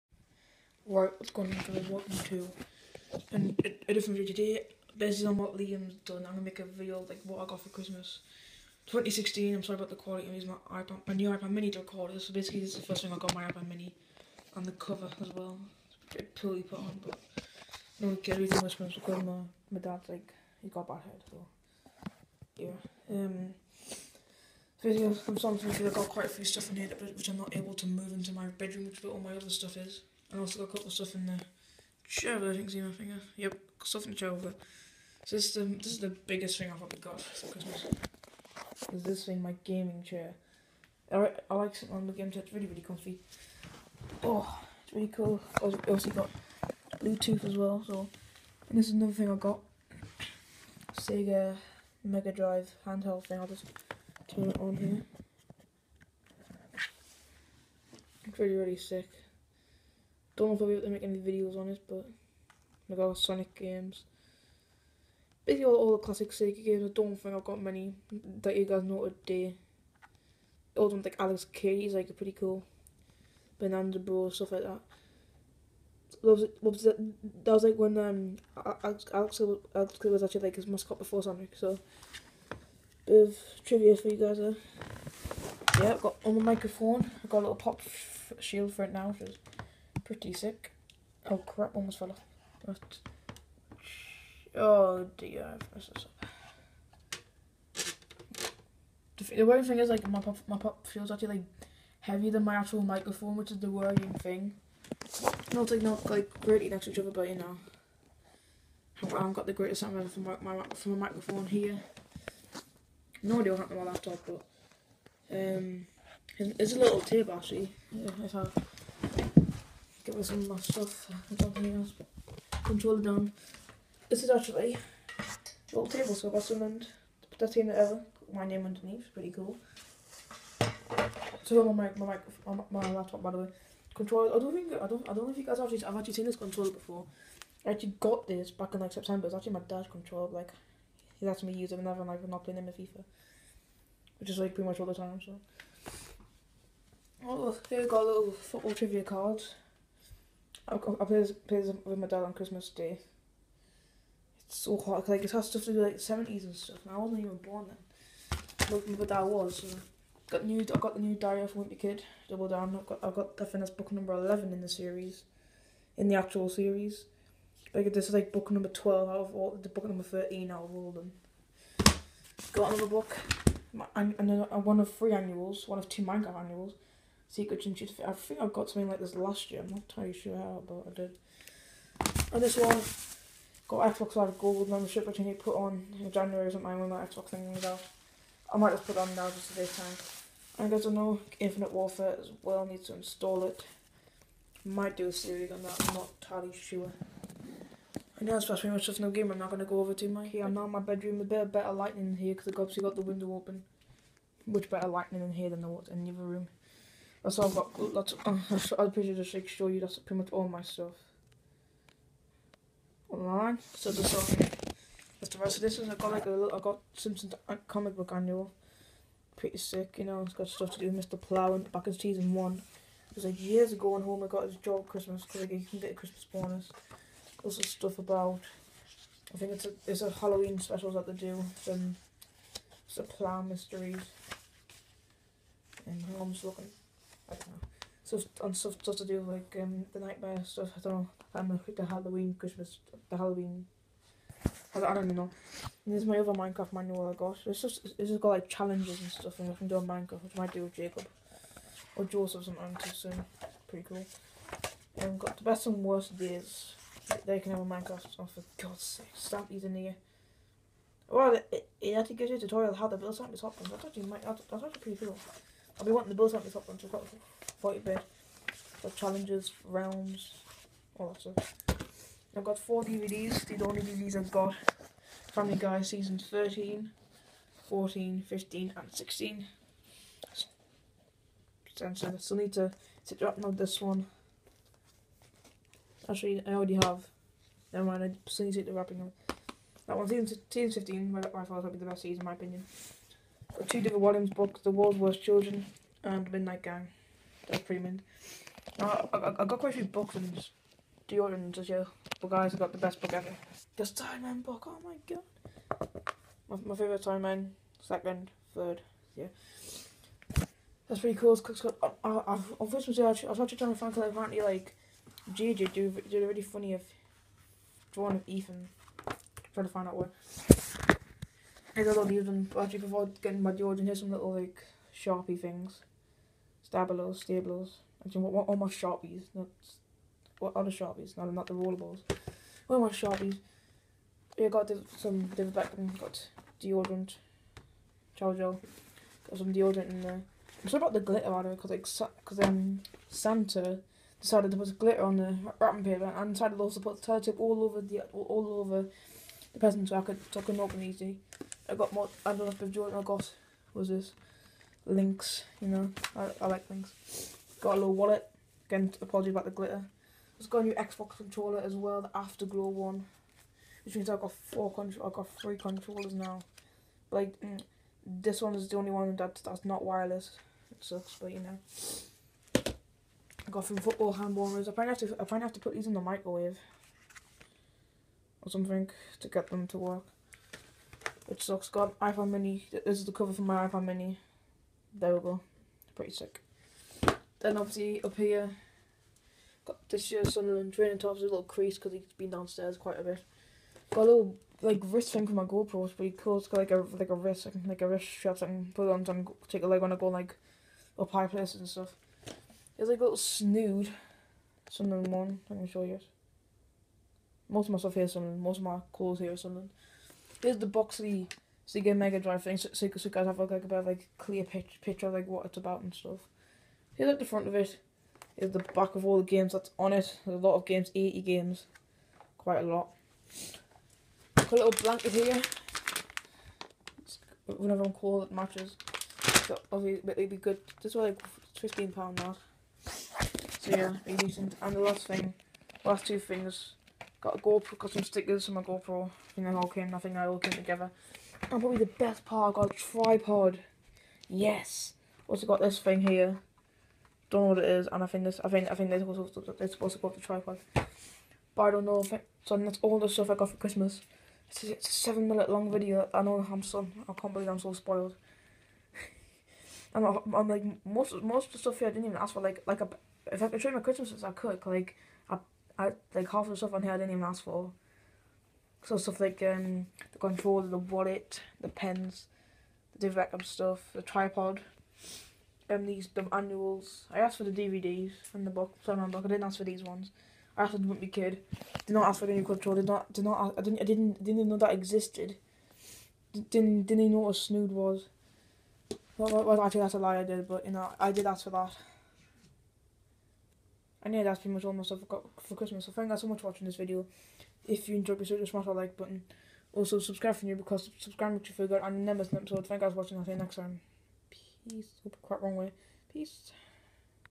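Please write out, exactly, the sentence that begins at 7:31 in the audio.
But I don't know if it, so that's all the stuff I got for Christmas.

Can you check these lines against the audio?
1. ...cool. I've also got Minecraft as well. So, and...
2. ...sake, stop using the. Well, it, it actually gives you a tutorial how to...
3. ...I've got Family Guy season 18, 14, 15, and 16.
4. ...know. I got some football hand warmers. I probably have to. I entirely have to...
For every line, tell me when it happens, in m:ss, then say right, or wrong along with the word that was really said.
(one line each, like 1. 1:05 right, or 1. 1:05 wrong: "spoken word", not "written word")
1. 0:45 wrong: "Bluetooth", not "Minecraft"
2. 4:18 right
3. 4:34 wrong: "13", not "18"
4. 6:11 wrong: "probably", not "entirely".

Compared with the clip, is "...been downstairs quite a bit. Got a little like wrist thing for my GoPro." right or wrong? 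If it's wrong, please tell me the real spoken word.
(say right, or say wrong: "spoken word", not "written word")
right.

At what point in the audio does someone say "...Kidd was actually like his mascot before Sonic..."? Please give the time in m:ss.
1:20.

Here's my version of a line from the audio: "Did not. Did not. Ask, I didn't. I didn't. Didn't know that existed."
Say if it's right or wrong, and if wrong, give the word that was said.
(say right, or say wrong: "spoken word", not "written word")
right.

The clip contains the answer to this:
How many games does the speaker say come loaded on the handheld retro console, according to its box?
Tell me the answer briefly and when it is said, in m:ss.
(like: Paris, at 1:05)
80, at 7:00.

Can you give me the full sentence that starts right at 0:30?
I also got a couple of stuff in the shower.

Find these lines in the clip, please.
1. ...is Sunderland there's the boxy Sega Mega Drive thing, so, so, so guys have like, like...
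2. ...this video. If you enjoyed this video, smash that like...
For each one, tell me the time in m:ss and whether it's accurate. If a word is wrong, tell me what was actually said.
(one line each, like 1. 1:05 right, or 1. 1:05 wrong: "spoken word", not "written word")
1. 6:49 right
2. 8:16 right.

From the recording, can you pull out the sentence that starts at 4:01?
I'm um, the Halloween, Christmas, the Halloween.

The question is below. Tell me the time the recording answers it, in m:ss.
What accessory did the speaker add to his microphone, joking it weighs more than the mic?
1:27.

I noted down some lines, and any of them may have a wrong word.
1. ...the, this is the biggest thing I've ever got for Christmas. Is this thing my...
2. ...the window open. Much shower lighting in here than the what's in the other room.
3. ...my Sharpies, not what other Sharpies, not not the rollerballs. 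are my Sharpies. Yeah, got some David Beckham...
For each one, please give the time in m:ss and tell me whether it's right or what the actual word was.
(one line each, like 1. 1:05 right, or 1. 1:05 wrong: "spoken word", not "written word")
1. 0:35 right
2. 3:22 wrong: "better", not "shower"
3. 5:28 right.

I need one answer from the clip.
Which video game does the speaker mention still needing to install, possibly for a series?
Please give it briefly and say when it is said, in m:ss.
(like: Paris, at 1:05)
Infinite Warfare, at 3:11.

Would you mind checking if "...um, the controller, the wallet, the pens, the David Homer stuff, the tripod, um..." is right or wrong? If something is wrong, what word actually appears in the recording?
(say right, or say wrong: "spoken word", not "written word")
wrong: "Beckham", not "Homer".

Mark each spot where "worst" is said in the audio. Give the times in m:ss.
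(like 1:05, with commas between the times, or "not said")
4:15, 4:54.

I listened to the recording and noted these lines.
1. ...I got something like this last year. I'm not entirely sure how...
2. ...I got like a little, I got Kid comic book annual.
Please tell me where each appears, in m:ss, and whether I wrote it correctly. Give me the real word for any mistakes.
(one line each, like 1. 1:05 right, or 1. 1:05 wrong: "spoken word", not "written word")
1. 2:58 right
2. 3:35 wrong: "Simpsons", not "Kid".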